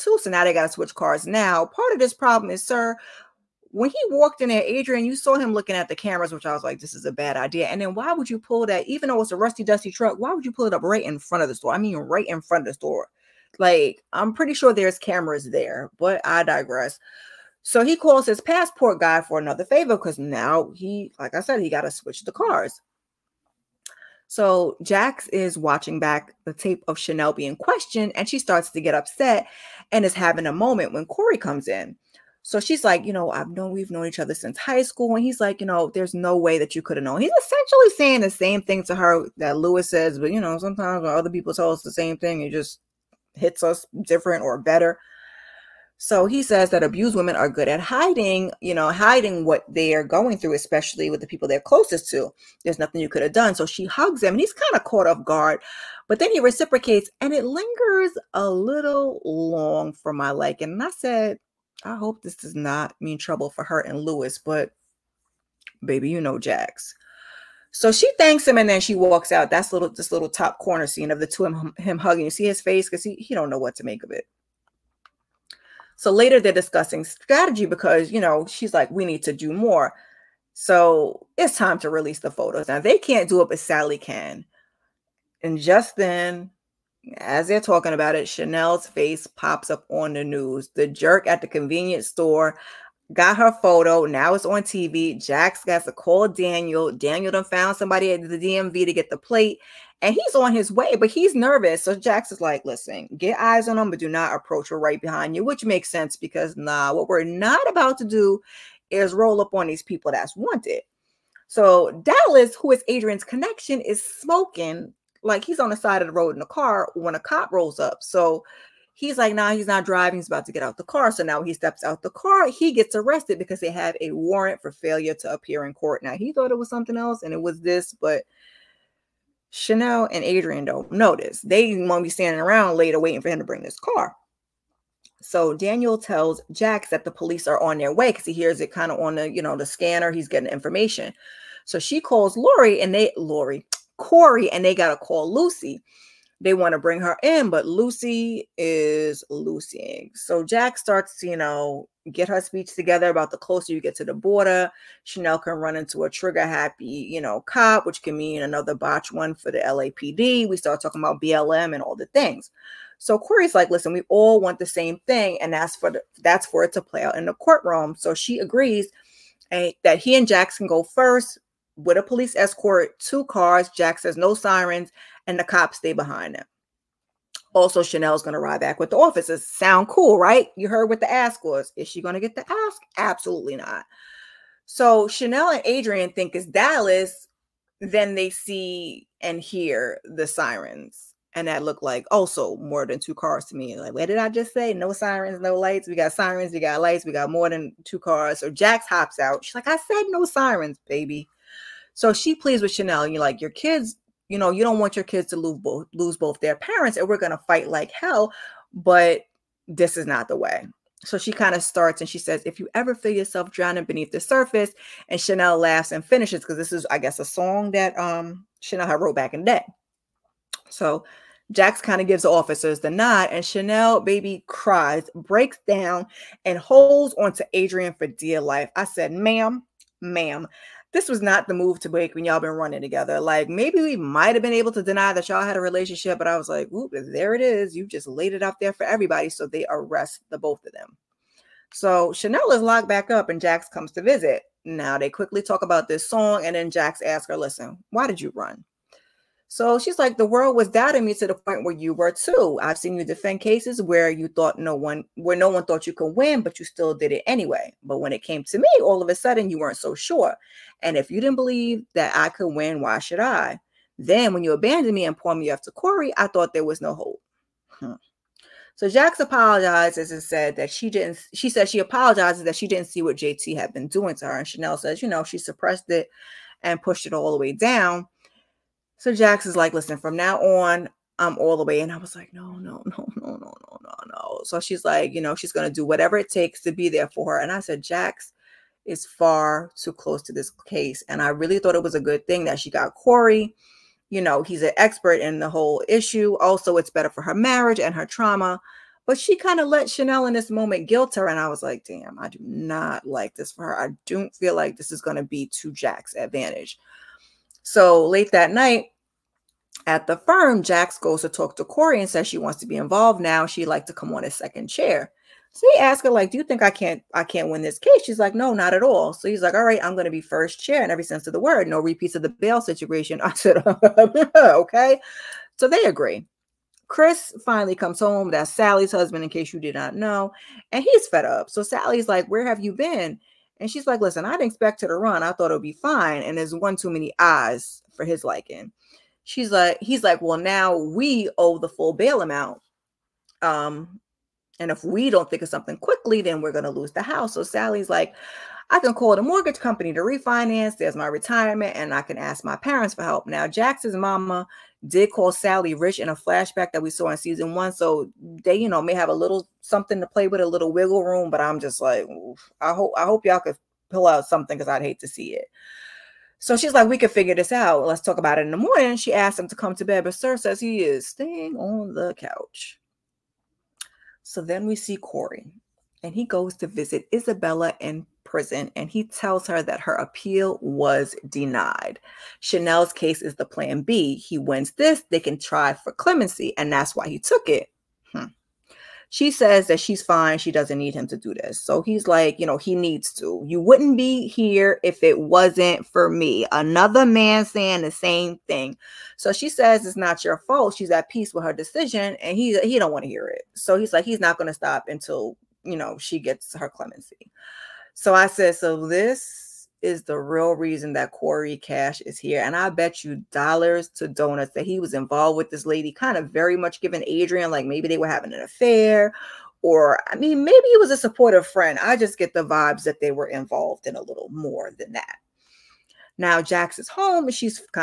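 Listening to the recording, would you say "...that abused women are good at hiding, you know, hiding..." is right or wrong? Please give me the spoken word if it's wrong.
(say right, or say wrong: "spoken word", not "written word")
right.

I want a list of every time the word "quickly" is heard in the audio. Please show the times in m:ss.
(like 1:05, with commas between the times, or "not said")
4:05, 5:45.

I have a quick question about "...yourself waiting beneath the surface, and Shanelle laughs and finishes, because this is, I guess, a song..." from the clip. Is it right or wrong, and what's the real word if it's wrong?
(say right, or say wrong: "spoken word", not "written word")
wrong: "drowning", not "waiting".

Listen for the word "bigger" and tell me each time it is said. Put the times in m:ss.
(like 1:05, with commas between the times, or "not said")
not said.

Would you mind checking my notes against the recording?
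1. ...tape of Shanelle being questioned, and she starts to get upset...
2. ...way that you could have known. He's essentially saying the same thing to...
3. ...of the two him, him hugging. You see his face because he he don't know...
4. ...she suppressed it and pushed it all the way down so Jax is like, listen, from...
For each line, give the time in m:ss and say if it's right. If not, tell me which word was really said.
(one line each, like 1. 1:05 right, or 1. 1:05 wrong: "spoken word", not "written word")
1. 0:26 right
2. 0:36 right
3. 1:11 right
4. 4:35 right.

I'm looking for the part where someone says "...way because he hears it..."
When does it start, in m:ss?
2:17.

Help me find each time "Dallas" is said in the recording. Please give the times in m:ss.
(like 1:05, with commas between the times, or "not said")
1:52, 3:06.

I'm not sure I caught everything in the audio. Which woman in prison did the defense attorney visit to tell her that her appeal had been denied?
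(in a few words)
Isabella.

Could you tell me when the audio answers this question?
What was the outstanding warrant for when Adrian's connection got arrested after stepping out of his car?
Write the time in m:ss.
2:04.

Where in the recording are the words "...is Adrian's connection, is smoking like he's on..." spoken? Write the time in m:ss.
1:52.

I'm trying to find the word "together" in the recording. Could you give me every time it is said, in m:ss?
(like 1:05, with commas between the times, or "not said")
2:32, 3:52.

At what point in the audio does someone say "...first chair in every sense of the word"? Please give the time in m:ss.
5:20.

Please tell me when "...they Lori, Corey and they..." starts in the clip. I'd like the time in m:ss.
2:22.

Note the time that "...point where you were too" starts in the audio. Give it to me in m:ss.
4:11.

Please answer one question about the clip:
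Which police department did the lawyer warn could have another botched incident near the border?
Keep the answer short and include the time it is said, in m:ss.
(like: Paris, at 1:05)
LAPD, at 2:39.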